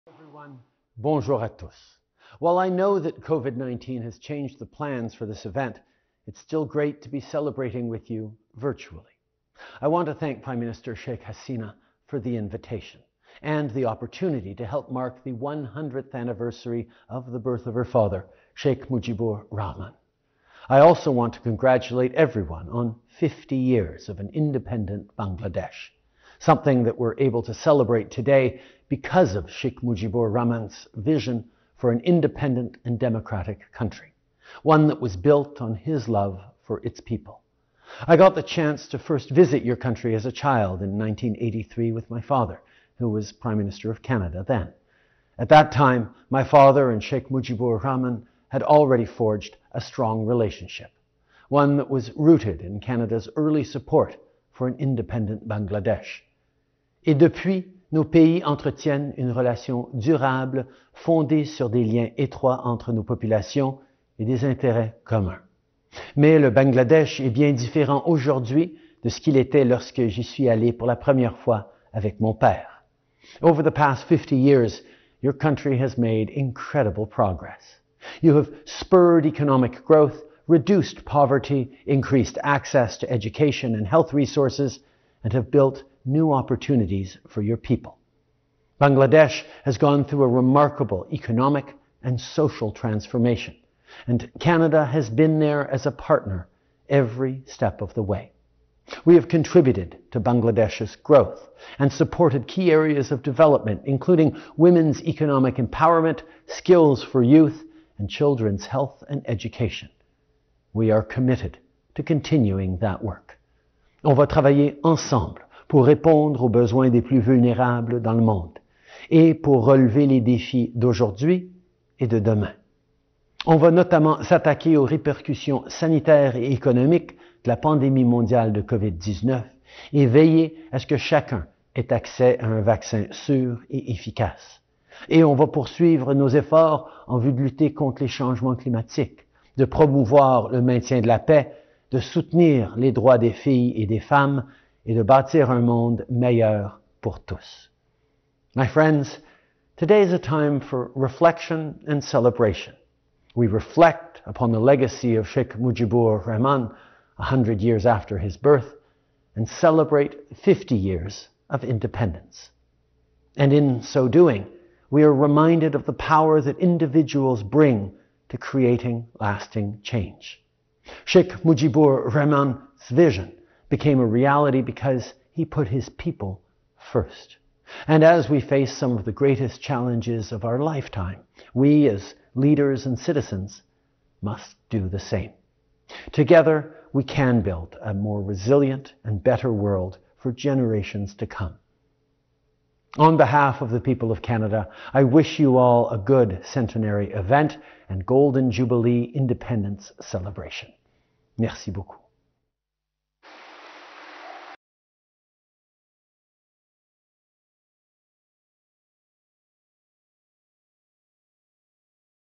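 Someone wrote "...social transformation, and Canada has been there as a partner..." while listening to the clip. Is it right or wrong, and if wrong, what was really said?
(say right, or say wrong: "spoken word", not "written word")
right.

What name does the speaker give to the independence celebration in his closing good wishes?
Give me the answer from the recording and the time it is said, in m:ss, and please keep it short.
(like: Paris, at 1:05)
Golden Jubilee, at 3:18.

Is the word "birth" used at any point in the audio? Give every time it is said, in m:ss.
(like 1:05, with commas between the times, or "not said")
0:17, 2:38.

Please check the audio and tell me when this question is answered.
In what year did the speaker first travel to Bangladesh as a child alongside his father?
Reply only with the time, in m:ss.
0:40.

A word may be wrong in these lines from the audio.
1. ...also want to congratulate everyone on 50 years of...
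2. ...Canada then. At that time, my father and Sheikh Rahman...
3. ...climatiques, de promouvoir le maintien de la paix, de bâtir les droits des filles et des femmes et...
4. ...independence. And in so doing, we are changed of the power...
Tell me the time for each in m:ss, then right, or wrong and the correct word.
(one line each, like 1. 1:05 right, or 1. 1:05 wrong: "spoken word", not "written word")
1. 0:20 right
2. 0:44 wrong: "Mujibur", not "Rahman"
3. 2:18 wrong: "soutenir", not "bâtir"
4. 2:41 wrong: "reminded", not "changed".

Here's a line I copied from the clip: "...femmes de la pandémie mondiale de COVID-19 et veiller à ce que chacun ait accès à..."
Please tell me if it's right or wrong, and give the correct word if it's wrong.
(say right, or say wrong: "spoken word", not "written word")
wrong: "économiques", not "femmes".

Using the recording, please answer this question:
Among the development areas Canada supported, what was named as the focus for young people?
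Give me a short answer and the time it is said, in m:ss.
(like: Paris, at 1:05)
skills for youth, at 1:46.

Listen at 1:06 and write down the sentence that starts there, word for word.
Mais le Bangladesh est bien différent aujourd'hui de ce qu'il était lorsque j'y suis allé pour la première fois avec mon père.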